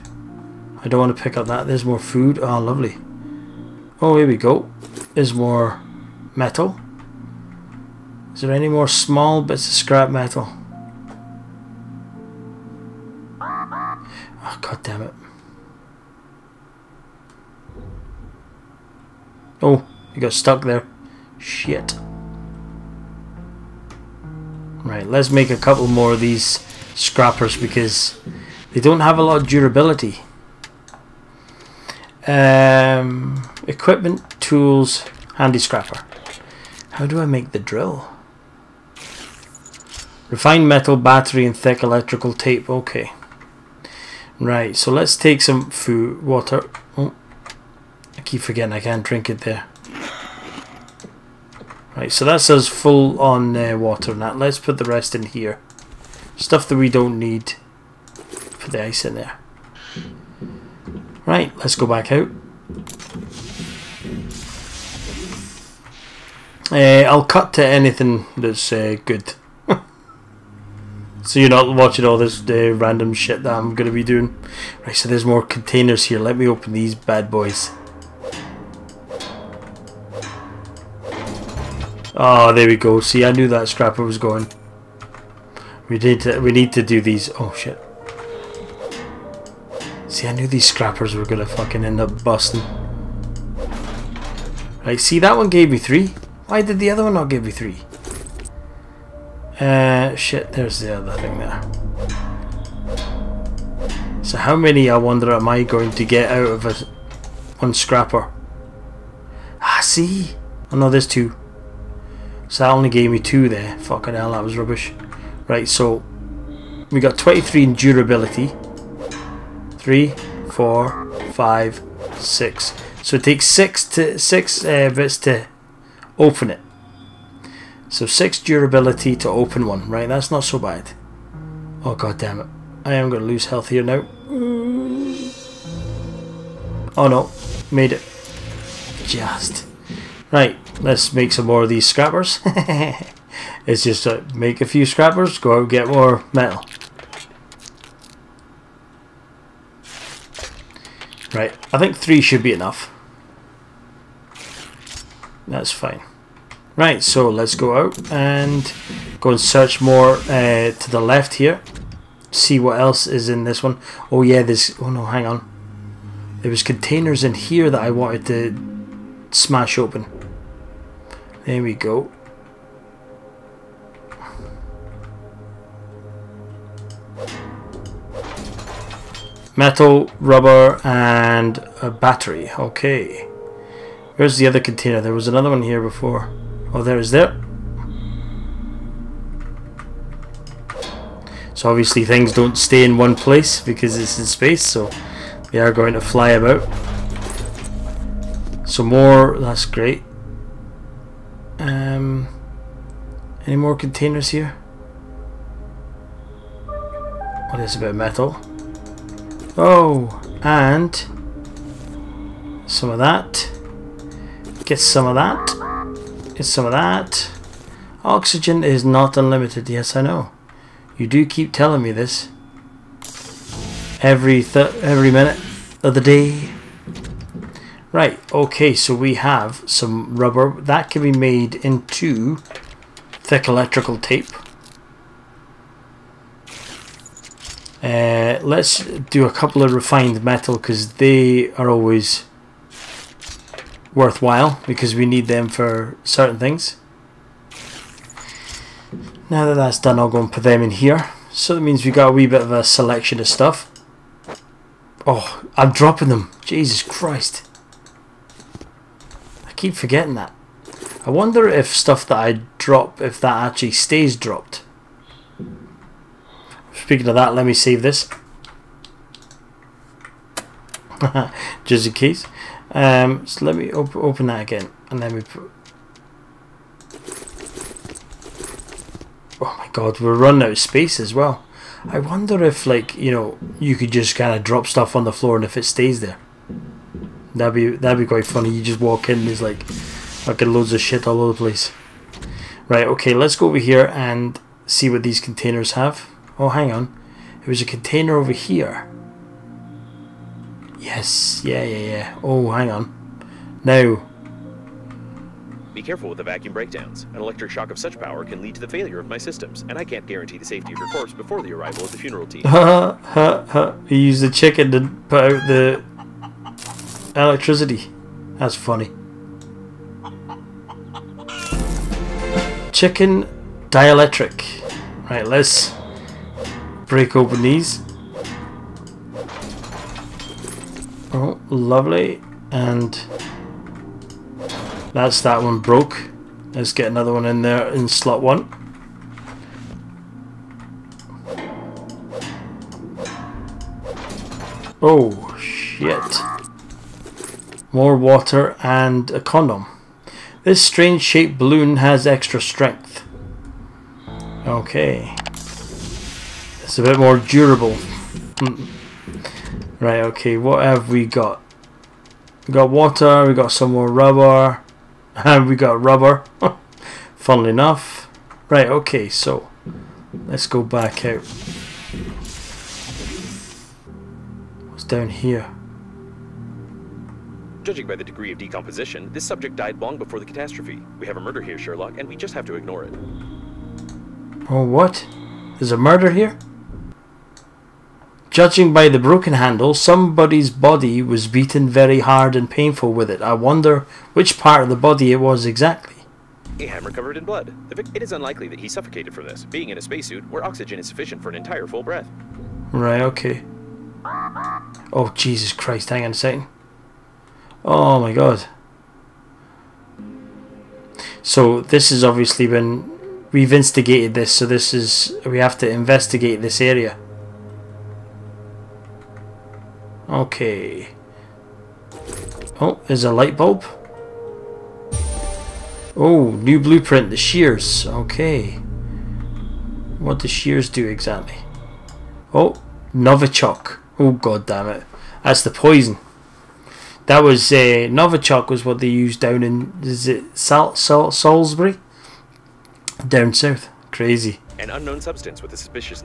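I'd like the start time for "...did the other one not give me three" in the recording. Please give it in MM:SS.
01:36.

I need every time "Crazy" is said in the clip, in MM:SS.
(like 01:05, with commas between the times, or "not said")
07:23.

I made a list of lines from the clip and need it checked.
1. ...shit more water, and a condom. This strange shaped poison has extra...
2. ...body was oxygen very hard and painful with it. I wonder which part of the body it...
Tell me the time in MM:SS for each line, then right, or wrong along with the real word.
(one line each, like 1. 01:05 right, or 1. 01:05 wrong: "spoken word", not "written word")
1. 05:45 wrong: "balloon", not "poison"
2. 06:30 wrong: "beaten", not "oxygen".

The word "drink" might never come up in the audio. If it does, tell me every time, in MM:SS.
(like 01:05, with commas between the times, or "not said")
00:49.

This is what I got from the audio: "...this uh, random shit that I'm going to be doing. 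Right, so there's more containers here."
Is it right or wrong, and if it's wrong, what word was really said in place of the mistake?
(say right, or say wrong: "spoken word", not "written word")
right.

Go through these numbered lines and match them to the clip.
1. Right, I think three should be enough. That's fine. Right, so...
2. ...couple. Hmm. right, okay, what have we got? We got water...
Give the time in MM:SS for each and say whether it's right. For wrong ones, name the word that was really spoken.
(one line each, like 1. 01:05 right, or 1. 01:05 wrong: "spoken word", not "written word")
1. 02:31 right
2. 05:57 wrong: "durable", not "couple".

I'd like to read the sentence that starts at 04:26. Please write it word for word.
Speaking of that, let me save this.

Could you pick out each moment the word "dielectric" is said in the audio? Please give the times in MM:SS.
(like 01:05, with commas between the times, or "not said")
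05:23.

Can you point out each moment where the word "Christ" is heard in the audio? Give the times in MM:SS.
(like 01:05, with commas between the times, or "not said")
04:16, 06:45.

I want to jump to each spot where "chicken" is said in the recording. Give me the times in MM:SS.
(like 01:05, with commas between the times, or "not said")
05:14, 05:22.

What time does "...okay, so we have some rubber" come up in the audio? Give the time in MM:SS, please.
03:48.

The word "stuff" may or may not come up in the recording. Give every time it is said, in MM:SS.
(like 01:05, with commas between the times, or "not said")
00:56, 04:13, 04:21, 04:44.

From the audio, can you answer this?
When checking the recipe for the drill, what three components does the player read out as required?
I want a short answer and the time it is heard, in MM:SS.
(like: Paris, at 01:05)
Refined metal, battery, and thick electrical tape, at 00:40.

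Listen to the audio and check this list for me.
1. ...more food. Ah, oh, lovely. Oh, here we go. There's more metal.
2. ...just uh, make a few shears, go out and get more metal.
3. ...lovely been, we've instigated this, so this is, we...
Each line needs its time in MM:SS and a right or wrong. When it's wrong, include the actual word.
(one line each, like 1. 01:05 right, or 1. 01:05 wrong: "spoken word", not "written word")
1. 00:01 right
2. 02:23 wrong: "scrappers", not "shears"
3. 06:52 wrong: "obviously", not "lovely".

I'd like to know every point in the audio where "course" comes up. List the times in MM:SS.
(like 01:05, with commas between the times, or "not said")
not said.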